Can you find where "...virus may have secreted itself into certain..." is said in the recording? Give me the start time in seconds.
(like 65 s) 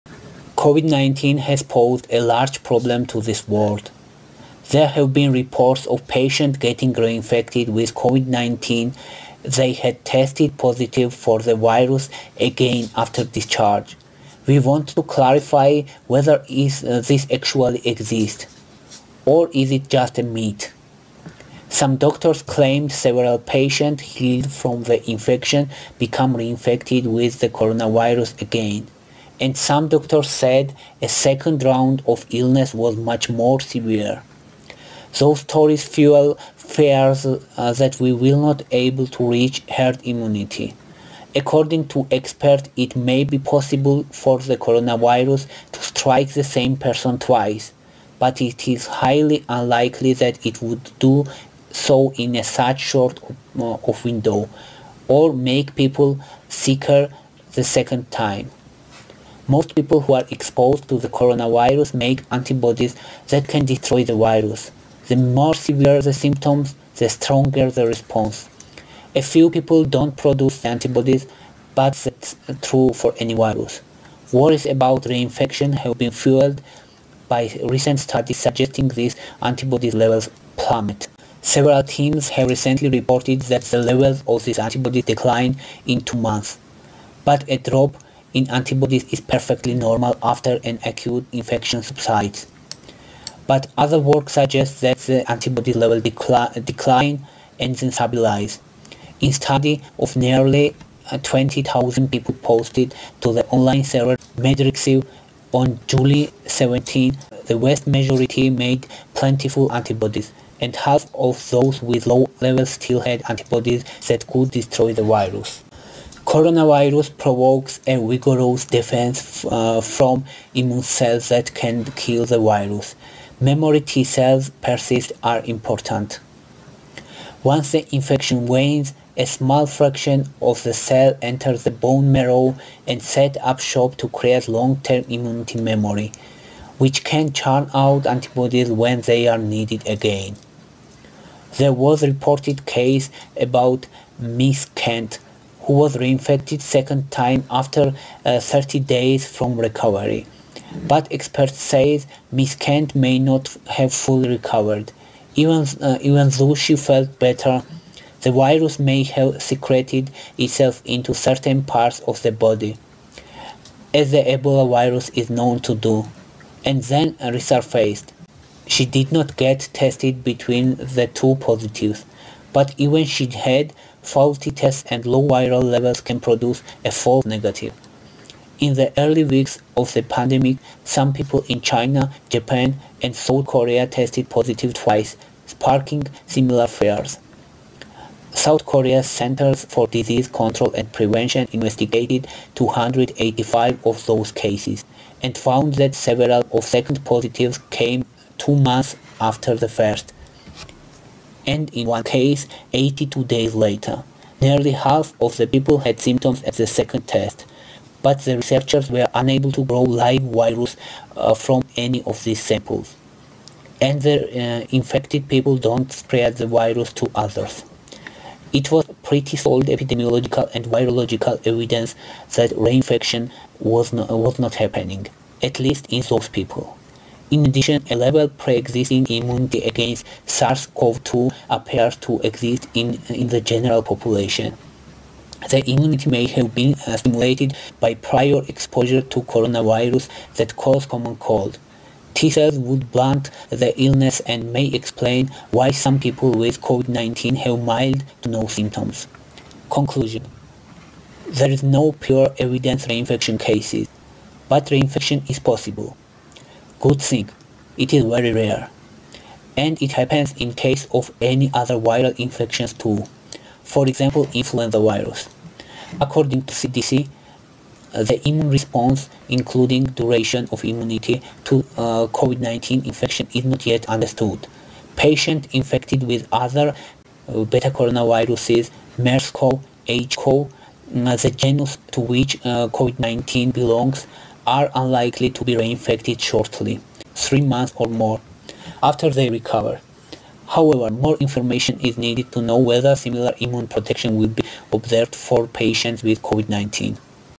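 158 s.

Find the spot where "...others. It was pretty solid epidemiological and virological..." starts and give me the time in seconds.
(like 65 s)
217 s.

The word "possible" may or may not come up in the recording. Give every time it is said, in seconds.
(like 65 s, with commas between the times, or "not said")
43 s, 255 s.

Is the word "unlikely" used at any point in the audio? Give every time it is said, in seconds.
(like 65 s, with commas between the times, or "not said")
49 s, 284 s.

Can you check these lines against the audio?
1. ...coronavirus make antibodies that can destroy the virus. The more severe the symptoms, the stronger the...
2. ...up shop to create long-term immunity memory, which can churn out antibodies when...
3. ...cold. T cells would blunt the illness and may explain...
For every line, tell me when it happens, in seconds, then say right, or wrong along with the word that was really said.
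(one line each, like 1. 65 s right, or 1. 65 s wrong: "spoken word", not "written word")
1. 61 s right
2. 133 s right
3. 241 s right.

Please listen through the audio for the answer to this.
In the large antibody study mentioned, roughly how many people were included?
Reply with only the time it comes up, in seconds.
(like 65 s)
101 s.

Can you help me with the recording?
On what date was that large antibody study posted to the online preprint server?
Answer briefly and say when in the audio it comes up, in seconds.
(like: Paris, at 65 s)
July 17, at 105 s.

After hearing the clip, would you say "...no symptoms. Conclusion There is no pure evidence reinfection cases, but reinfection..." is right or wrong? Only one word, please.
right.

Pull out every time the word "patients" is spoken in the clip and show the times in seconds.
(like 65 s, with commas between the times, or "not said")
6 s, 23 s, 274 s, 295 s.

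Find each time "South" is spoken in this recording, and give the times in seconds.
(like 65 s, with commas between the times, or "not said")
183 s, 188 s.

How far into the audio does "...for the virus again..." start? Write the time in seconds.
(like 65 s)
11 s.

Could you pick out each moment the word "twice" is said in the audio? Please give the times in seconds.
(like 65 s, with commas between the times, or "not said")
47 s, 184 s.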